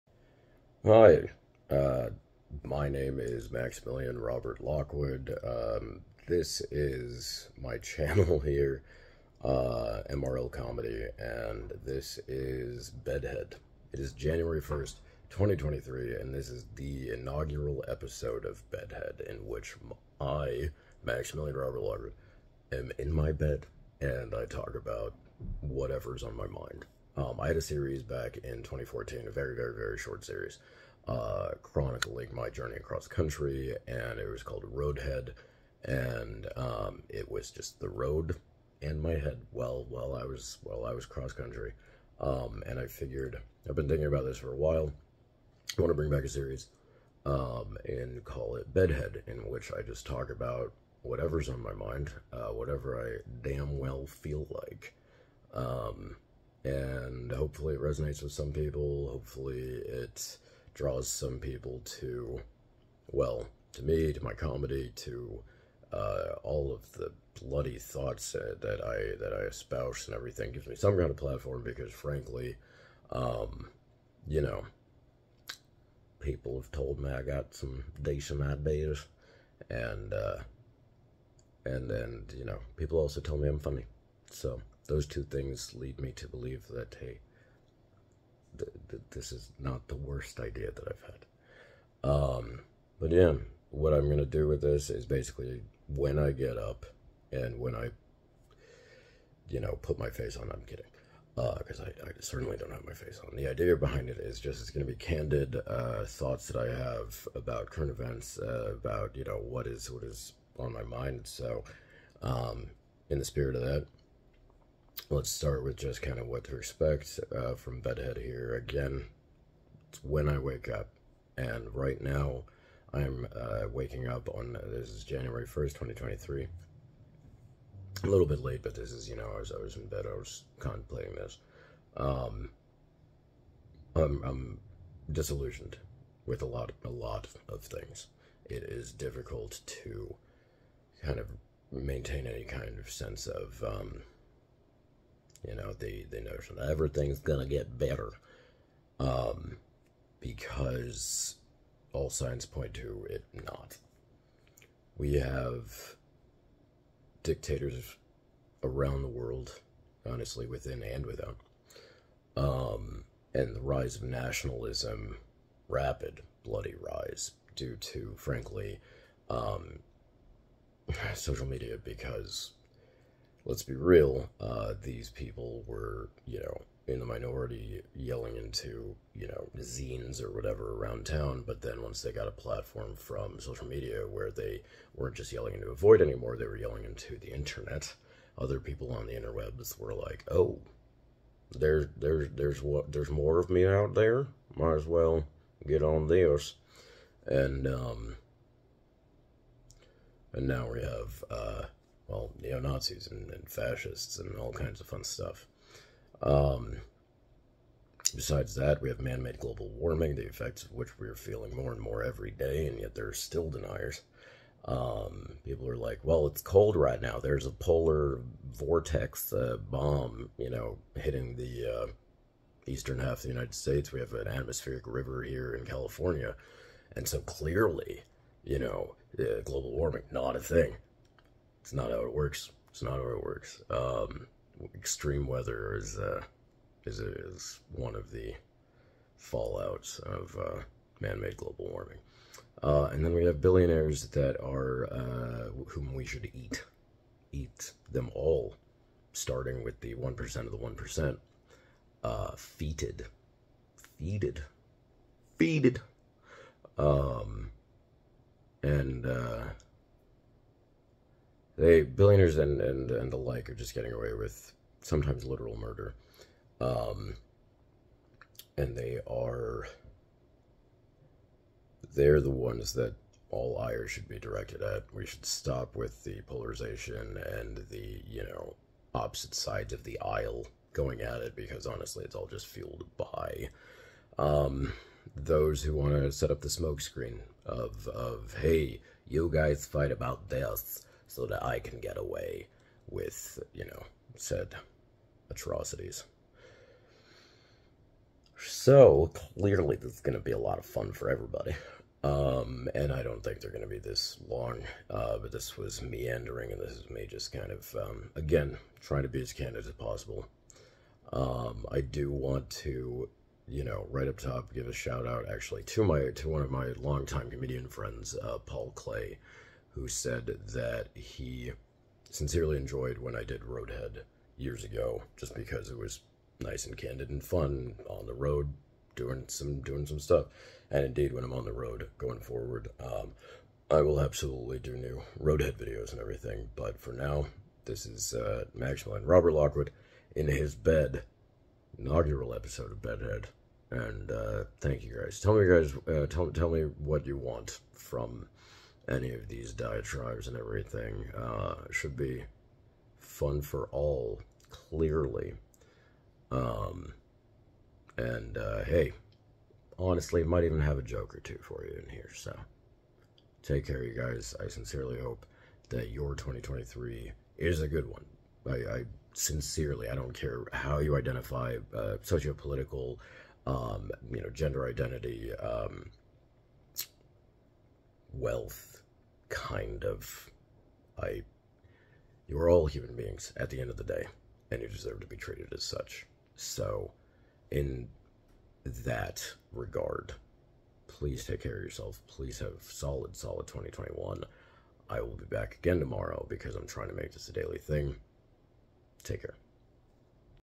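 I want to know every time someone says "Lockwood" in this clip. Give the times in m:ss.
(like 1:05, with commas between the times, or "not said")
0:04, 0:21, 5:39.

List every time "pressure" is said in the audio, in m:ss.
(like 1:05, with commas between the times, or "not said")
not said.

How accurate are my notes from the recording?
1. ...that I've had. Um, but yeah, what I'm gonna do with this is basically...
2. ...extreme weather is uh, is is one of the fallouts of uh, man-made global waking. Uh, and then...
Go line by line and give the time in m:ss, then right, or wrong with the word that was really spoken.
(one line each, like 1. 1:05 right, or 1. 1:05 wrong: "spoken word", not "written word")
1. 1:30 right
2. 3:54 wrong: "warming", not "waking".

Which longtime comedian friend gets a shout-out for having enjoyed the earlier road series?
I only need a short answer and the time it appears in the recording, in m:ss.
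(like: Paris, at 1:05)
Paul Clay, at 5:18.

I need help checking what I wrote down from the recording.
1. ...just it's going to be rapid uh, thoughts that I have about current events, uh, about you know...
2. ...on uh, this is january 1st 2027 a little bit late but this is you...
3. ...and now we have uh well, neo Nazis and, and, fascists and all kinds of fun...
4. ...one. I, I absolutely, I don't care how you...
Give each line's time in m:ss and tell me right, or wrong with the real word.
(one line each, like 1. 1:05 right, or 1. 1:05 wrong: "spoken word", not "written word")
1. 1:44 wrong: "candid", not "rapid"
2. 2:04 wrong: "2023", not "2027"
3. 3:20 right
4. 6:07 wrong: "sincerely", not "absolutely".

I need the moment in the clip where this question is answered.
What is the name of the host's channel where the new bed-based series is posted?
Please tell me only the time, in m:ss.
0:10.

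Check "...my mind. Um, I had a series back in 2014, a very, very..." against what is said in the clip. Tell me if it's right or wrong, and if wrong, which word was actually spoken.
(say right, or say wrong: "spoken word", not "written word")
right.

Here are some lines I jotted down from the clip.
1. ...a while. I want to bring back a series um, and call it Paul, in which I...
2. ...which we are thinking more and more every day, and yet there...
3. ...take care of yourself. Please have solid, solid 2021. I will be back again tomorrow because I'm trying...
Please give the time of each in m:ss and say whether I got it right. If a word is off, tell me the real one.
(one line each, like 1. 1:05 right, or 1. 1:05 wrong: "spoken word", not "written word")
1. 0:44 wrong: "Bedhead", not "Paul"
2. 3:30 wrong: "feeling", not "thinking"
3. 6:31 right.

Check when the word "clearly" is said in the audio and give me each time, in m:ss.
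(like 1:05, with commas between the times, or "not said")
3:47, 4:59, 5:54.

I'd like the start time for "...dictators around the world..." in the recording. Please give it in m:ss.
2:37.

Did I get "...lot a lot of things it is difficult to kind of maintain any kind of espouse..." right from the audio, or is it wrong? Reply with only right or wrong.
wrong.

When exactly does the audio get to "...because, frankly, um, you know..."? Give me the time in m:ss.
1:11.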